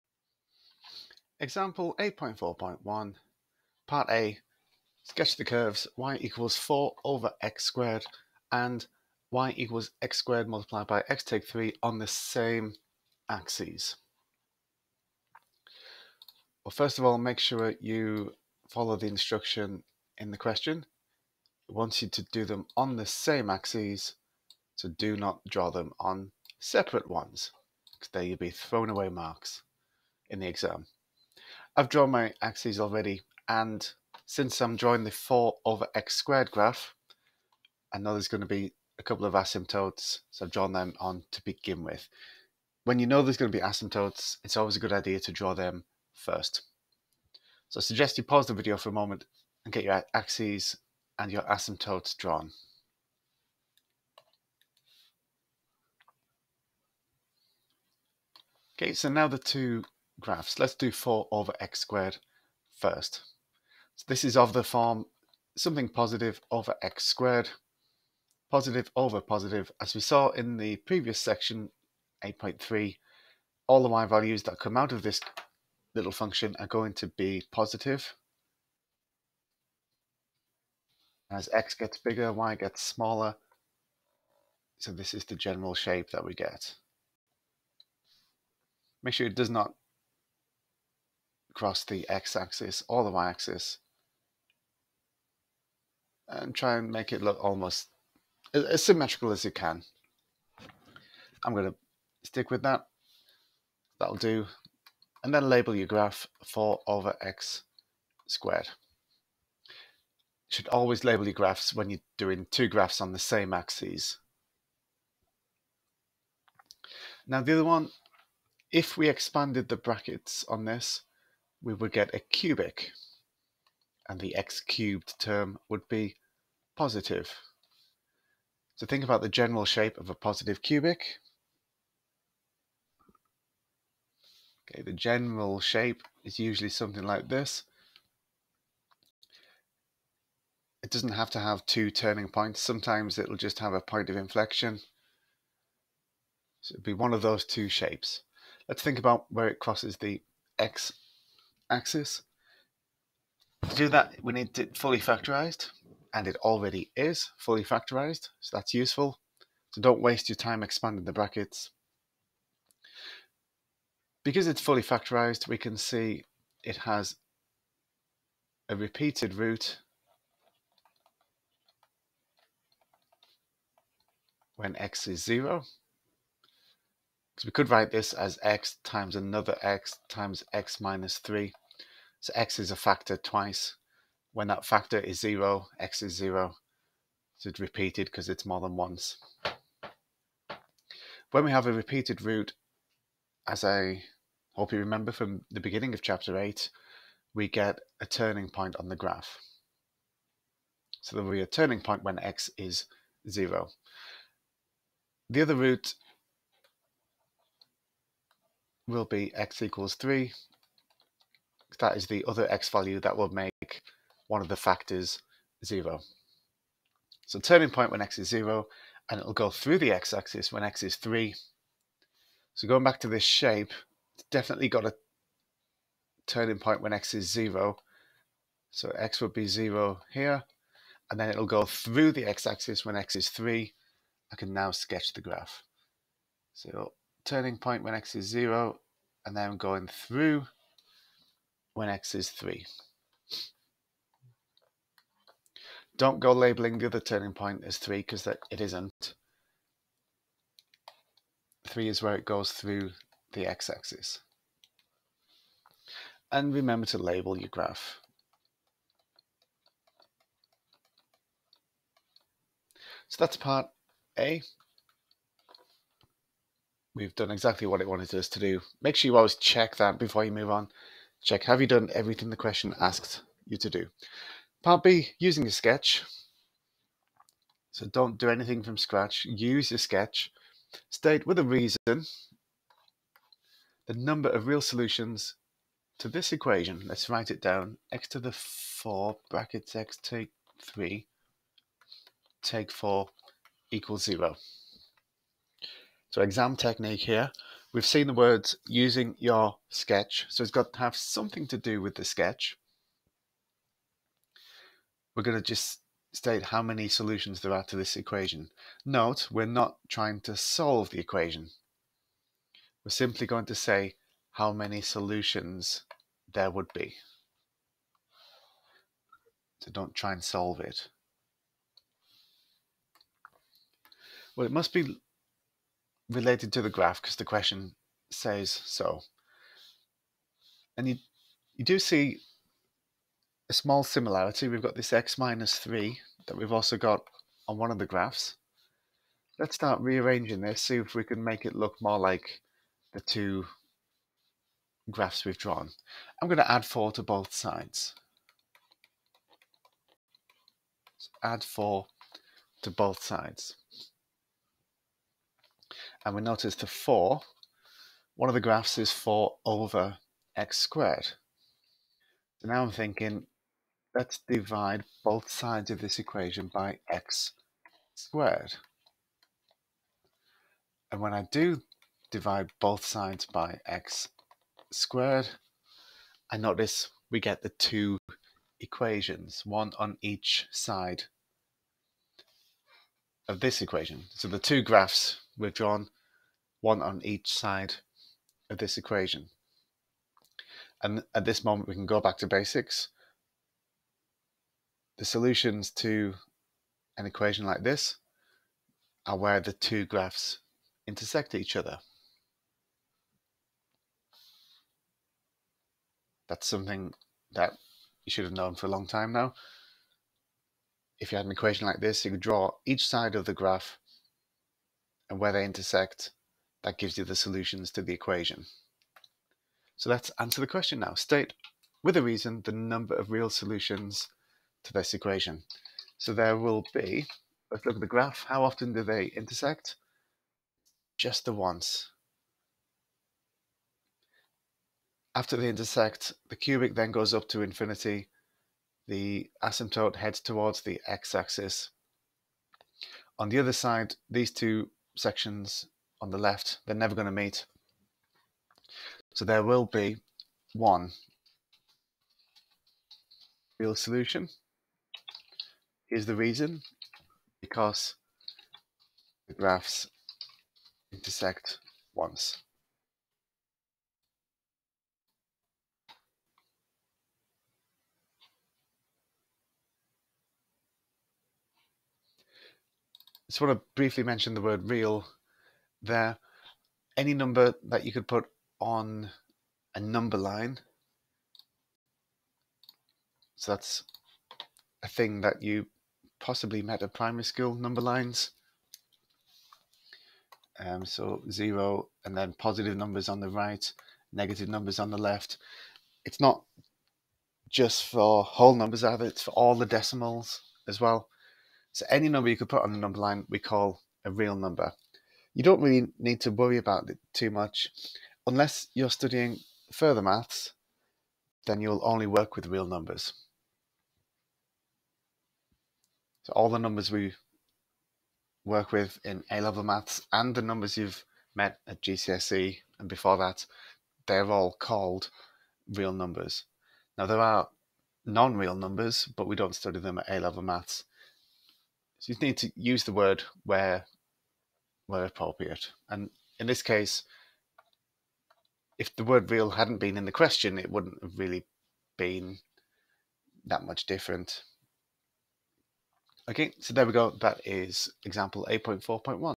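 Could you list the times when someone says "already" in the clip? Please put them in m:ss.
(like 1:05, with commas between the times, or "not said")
0:32, 2:36.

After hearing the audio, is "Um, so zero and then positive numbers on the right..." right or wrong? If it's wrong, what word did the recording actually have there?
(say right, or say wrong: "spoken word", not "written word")
right.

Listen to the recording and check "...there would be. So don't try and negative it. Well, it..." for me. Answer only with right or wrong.
wrong.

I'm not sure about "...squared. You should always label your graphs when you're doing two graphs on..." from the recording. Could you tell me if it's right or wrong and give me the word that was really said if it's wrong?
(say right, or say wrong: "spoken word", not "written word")
right.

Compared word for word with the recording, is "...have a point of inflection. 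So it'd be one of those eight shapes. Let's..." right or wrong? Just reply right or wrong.
wrong.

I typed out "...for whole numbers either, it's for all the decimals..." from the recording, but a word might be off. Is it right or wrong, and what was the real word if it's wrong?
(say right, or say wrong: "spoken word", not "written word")
right.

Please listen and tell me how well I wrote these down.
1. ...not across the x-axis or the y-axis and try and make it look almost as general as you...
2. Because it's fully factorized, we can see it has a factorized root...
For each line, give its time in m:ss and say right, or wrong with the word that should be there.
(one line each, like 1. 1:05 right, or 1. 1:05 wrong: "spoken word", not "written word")
1. 1:29 wrong: "symmetrical", not "general"
2. 2:44 wrong: "repeated", not "factorized".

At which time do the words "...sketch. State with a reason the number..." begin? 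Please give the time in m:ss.
4:39.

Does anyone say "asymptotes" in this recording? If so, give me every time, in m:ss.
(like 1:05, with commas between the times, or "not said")
0:39, 0:43, 0:51, 7:19.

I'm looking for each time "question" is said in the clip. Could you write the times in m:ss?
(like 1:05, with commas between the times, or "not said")
0:20, 4:32, 5:27, 7:00, 9:00.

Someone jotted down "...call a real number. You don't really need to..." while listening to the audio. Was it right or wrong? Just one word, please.
right.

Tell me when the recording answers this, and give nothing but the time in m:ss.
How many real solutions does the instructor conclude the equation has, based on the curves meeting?
7:30.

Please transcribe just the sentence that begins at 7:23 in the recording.
On the other side, these two sections on the left, they're never going to meet.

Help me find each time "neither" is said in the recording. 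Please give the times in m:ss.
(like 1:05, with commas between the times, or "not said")
not said.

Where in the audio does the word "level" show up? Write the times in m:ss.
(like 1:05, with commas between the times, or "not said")
8:39, 8:50.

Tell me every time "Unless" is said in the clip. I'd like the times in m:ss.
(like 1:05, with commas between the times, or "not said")
8:28.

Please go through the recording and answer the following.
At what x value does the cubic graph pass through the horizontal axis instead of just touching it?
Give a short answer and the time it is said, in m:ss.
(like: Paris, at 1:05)
3, at 3:29.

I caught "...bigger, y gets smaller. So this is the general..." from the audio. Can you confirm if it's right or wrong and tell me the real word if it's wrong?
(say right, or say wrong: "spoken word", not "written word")
right.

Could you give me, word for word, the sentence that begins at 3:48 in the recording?
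So x would be 0 here, and then it'll go through the x-axis when x is 3.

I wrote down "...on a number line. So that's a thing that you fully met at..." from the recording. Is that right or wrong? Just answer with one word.
wrong.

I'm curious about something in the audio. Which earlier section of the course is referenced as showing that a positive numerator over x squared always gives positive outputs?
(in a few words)
8.3.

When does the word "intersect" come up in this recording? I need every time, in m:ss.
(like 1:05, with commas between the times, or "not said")
6:40, 6:55, 7:09, 7:15, 7:40.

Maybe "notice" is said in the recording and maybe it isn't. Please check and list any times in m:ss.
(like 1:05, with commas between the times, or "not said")
5:56, 6:16.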